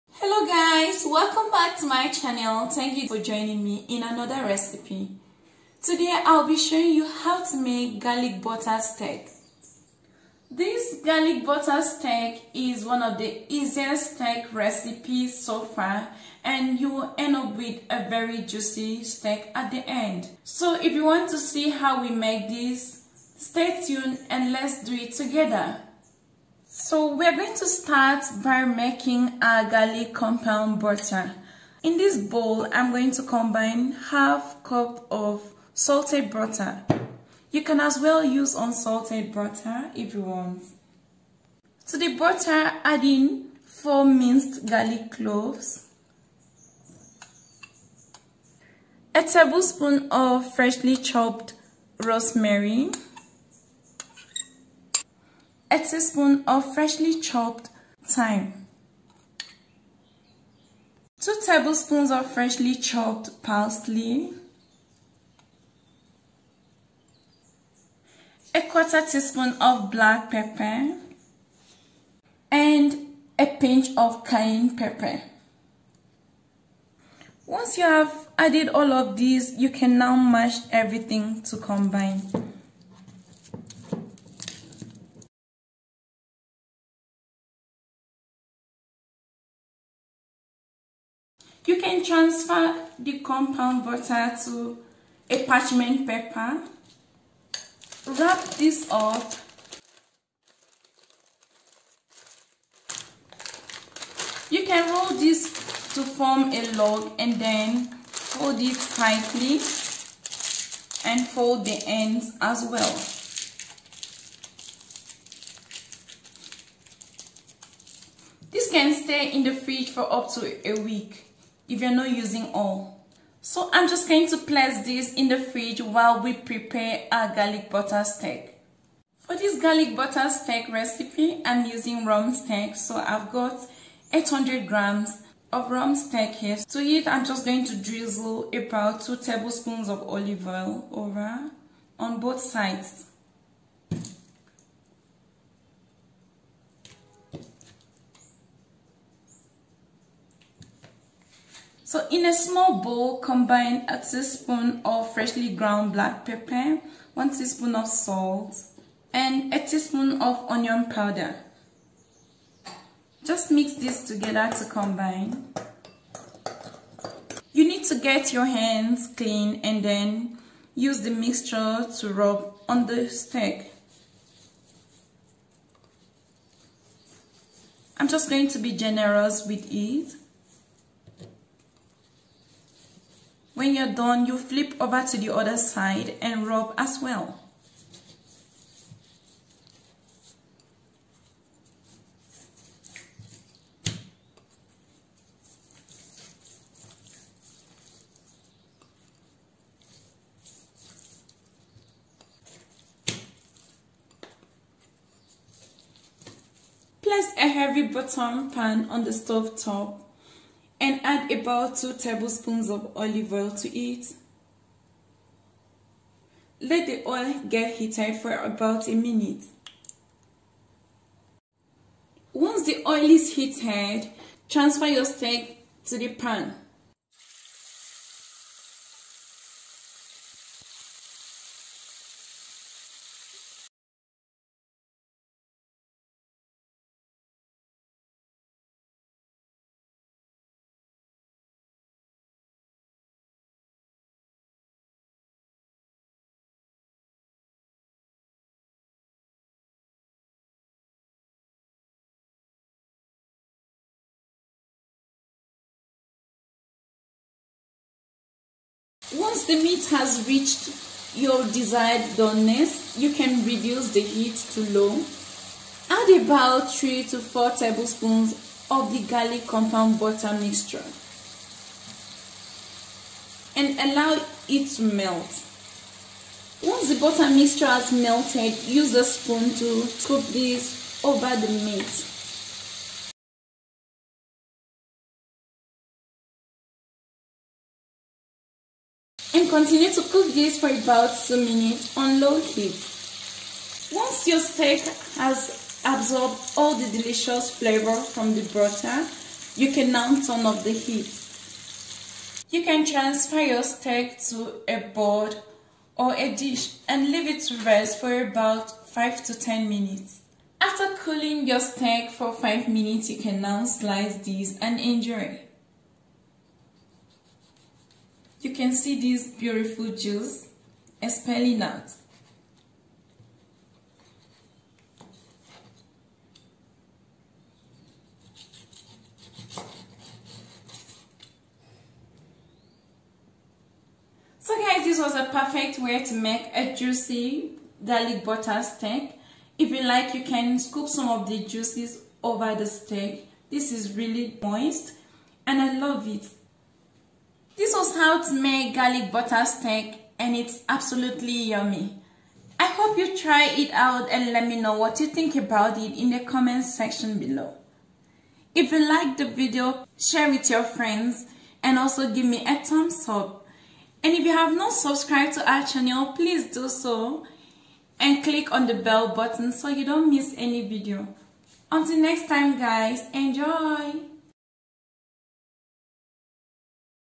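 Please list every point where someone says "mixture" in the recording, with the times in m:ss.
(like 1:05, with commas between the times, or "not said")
2:51, 4:30, 4:37.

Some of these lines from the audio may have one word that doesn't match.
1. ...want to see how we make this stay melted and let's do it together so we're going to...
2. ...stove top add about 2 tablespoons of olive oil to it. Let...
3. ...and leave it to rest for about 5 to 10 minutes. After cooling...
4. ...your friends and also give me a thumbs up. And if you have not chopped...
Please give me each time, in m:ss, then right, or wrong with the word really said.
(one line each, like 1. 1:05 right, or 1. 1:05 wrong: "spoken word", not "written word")
1. 0:21 wrong: "tuned", not "melted"
2. 3:29 right
3. 5:06 right
4. 6:00 wrong: "subscribed", not "chopped".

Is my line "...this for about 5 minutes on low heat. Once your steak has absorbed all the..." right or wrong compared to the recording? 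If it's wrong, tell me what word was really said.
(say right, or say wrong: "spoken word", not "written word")
wrong: "2", not "5".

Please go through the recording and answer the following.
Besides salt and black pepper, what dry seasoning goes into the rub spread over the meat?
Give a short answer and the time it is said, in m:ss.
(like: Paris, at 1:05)
Onion powder, at 2:40.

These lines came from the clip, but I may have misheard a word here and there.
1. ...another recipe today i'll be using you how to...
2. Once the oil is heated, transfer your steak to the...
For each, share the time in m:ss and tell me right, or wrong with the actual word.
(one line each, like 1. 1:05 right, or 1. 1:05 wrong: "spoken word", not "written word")
1. 0:04 wrong: "showing", not "using"
2. 3:42 right.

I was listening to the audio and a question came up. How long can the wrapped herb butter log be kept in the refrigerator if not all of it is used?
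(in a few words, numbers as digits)
Up to a week.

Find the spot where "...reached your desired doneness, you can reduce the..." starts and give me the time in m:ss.
4:20.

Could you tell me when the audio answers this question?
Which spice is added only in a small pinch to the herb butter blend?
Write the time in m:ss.
1:14.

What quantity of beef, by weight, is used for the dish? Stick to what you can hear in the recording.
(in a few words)
800 grams.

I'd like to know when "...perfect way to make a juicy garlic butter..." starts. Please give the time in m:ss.
5:35.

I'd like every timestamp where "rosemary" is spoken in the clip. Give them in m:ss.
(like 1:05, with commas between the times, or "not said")
0:52.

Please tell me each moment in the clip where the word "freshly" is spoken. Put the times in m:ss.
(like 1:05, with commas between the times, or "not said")
0:50, 0:56, 1:02, 2:35.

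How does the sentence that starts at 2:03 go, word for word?
So I'm just going to place this in the fridge while we prepare our garlic butter steak.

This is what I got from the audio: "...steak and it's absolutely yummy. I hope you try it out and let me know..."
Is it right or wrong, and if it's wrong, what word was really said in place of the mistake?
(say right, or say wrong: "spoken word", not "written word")
right.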